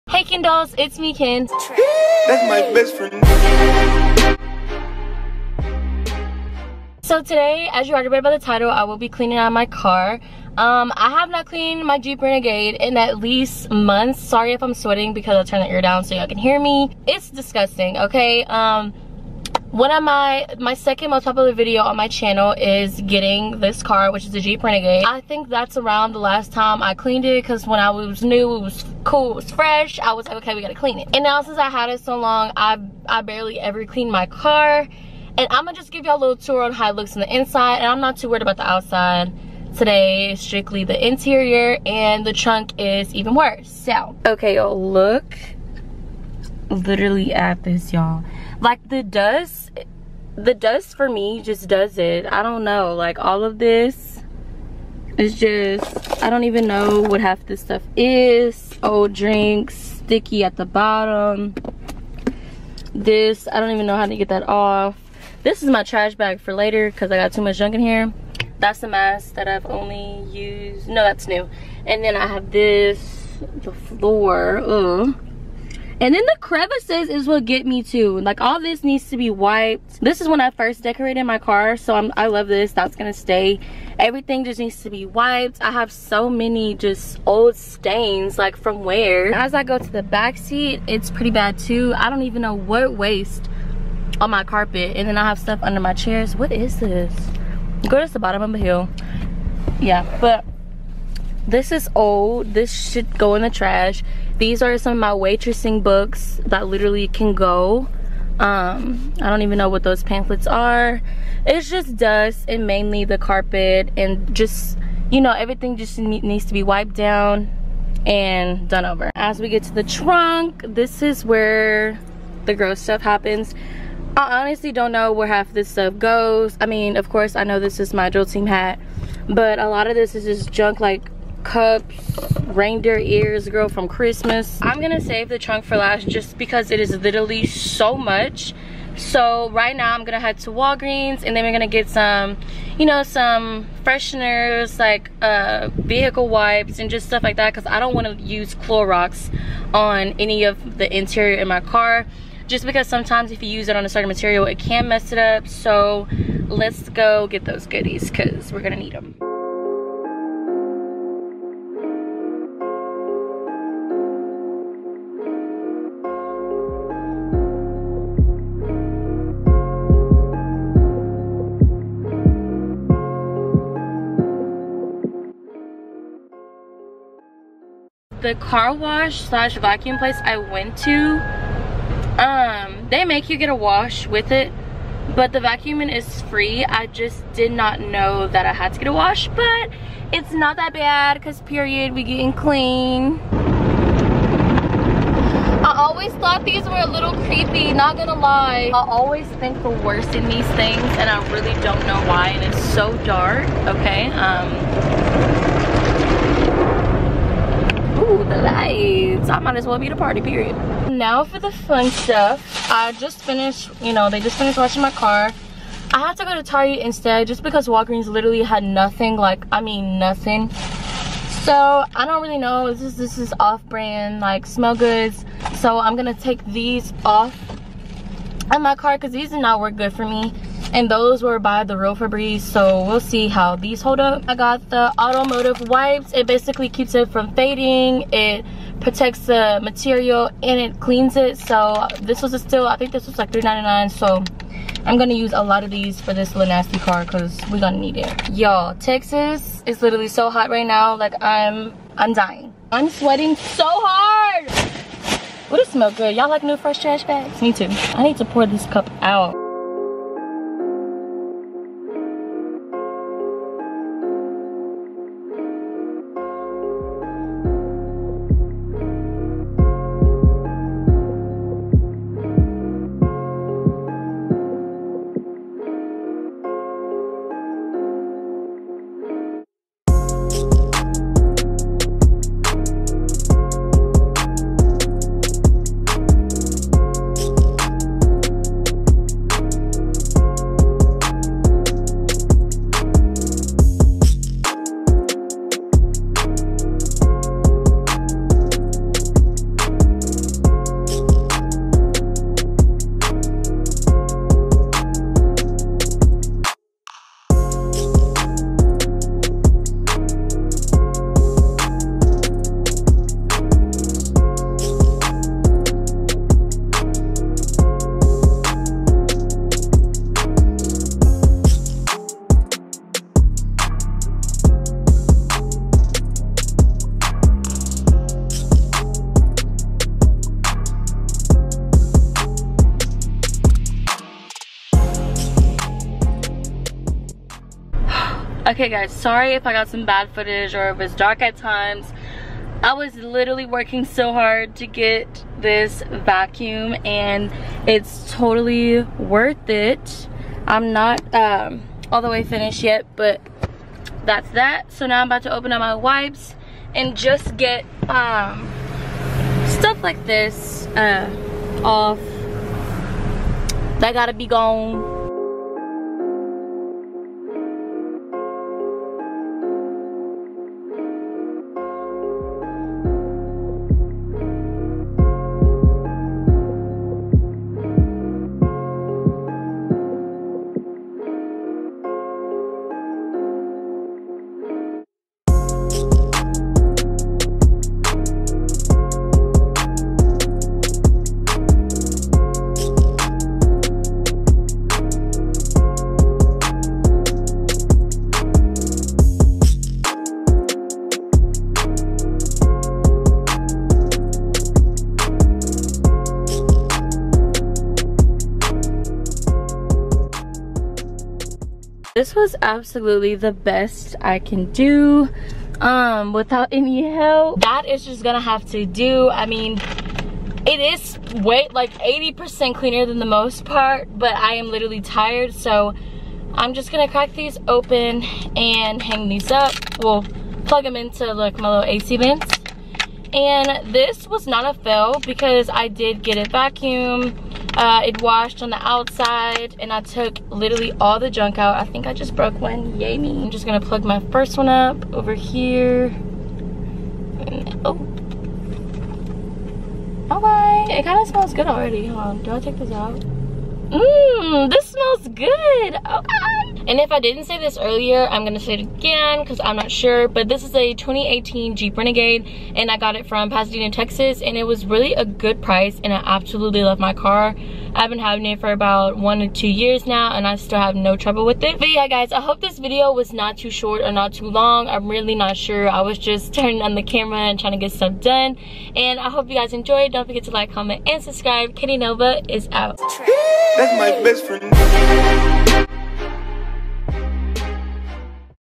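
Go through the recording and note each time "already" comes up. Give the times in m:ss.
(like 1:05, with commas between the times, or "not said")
0:07, 7:31.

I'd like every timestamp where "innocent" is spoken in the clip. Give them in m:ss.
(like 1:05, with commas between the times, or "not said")
not said.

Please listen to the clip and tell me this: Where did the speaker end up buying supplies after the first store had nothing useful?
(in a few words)
Target.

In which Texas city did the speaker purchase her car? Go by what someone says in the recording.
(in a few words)
Pasadena.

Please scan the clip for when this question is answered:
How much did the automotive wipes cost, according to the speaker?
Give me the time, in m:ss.
4:03.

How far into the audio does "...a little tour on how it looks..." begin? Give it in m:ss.
0:36.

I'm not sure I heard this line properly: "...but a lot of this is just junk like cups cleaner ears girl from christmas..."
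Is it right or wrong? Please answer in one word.
wrong.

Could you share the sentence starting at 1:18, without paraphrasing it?
Like all this needs to be wiped.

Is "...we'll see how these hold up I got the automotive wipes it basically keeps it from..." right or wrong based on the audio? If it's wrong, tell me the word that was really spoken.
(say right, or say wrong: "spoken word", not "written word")
right.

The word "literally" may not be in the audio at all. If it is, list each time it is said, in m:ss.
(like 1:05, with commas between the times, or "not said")
0:46, 1:46, 2:16, 3:38, 4:09, 5:42, 7:04, 7:20.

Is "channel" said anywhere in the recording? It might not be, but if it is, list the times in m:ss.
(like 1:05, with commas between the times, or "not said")
0:22.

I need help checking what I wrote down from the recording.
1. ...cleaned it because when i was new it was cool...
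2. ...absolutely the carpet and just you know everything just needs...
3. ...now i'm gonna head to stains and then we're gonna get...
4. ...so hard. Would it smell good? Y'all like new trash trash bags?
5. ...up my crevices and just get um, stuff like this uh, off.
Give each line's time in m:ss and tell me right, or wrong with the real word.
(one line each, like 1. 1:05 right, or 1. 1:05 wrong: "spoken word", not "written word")
1. 0:26 right
2. 1:52 wrong: "mainly", not "absolutely"
3. 2:19 wrong: "walgreens", not "stains"
4. 4:13 wrong: "fresh", not "trash"
5. 5:55 wrong: "wipes", not "crevices".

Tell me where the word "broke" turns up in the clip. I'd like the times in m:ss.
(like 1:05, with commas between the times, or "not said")
7:22.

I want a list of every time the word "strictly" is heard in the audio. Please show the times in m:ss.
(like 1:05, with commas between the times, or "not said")
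0:40.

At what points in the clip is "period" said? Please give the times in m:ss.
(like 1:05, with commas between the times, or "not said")
3:11, 3:30.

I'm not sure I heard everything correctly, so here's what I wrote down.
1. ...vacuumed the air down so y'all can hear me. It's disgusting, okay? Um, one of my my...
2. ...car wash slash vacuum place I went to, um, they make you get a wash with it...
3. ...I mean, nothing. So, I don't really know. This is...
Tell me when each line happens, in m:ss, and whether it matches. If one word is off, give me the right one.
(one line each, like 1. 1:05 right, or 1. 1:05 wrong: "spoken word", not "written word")
1. 0:15 wrong: "turned", not "vacuumed"
2. 2:58 right
3. 3:39 right.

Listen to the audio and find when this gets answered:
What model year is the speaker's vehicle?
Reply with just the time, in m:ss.
7:40.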